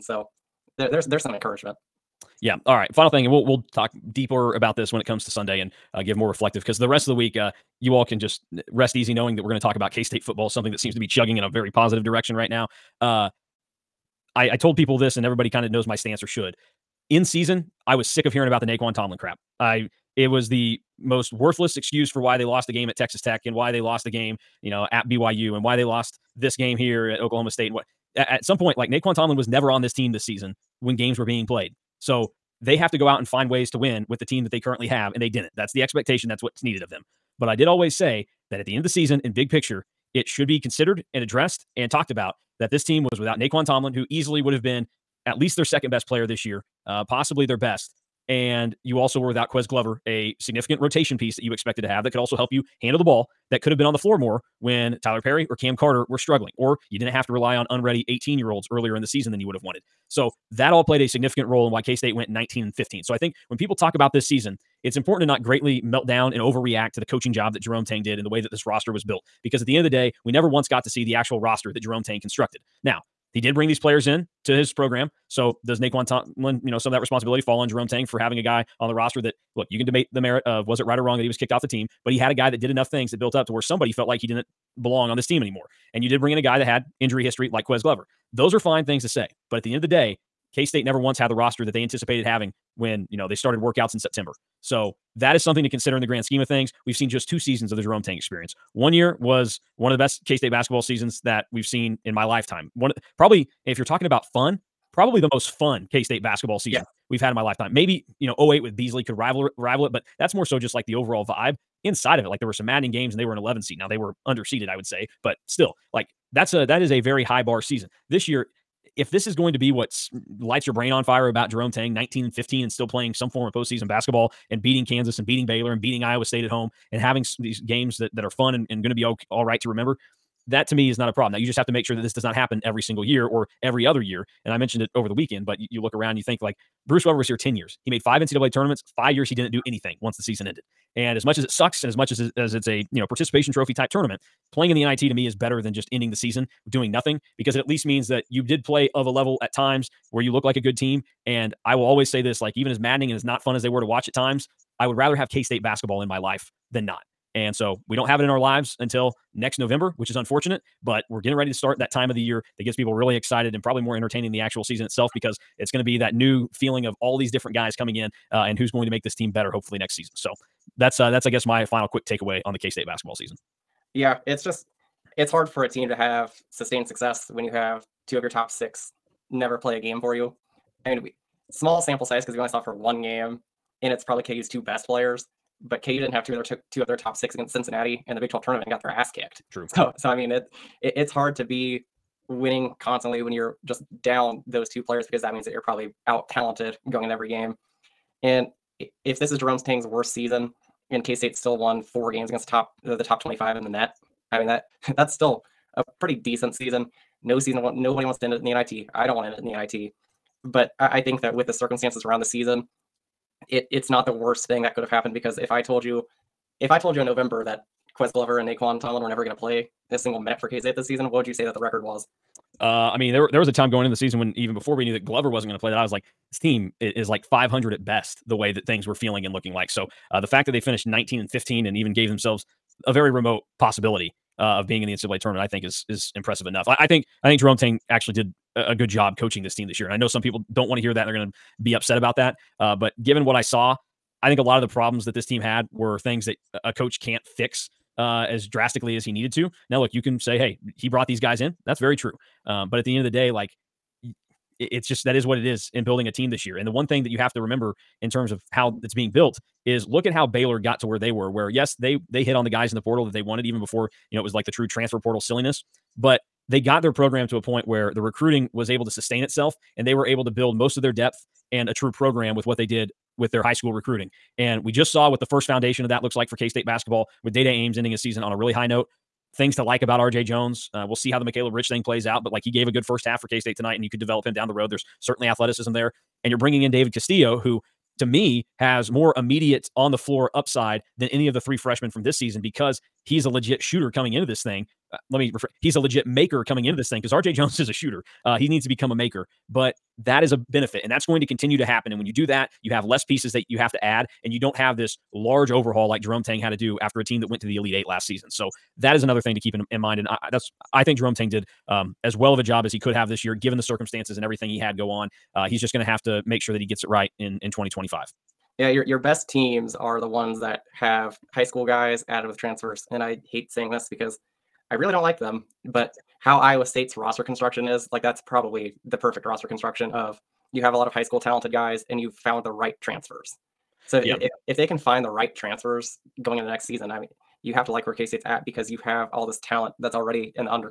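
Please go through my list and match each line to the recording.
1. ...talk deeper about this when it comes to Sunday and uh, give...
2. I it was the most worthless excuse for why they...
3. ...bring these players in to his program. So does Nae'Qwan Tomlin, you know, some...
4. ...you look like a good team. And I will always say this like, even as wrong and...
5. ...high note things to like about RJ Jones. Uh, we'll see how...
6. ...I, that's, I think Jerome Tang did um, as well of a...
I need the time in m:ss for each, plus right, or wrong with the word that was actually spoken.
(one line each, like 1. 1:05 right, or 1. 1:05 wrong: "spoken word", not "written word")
1. 0:03 right
2. 0:19 right
3. 1:13 right
4. 2:30 wrong: "maddening", not "wrong"
5. 4:38 right
6. 5:10 right.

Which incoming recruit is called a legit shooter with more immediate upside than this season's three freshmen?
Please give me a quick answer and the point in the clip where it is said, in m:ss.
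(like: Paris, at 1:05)
David Castillo, at 4:46.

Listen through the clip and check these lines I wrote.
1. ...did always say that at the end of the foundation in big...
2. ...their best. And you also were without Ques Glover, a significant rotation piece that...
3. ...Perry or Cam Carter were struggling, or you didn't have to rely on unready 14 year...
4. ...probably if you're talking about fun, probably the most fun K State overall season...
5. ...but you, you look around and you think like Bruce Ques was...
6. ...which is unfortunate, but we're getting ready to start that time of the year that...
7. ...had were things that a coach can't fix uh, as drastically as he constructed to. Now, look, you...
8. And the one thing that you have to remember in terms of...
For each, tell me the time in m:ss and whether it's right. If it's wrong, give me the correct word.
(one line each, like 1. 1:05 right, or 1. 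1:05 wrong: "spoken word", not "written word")
1. 0:37 wrong: "season", not "foundation"
2. 0:47 right
3. 0:55 wrong: "18", not "14"
4. 1:43 wrong: "basketball", not "overall"
5. 2:15 wrong: "Weber", not "Ques"
6. 2:39 right
7. 4:05 wrong: "needed", not "constructed"
8. 4:16 right.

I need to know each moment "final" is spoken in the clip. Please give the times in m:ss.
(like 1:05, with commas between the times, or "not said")
0:02, 2:51.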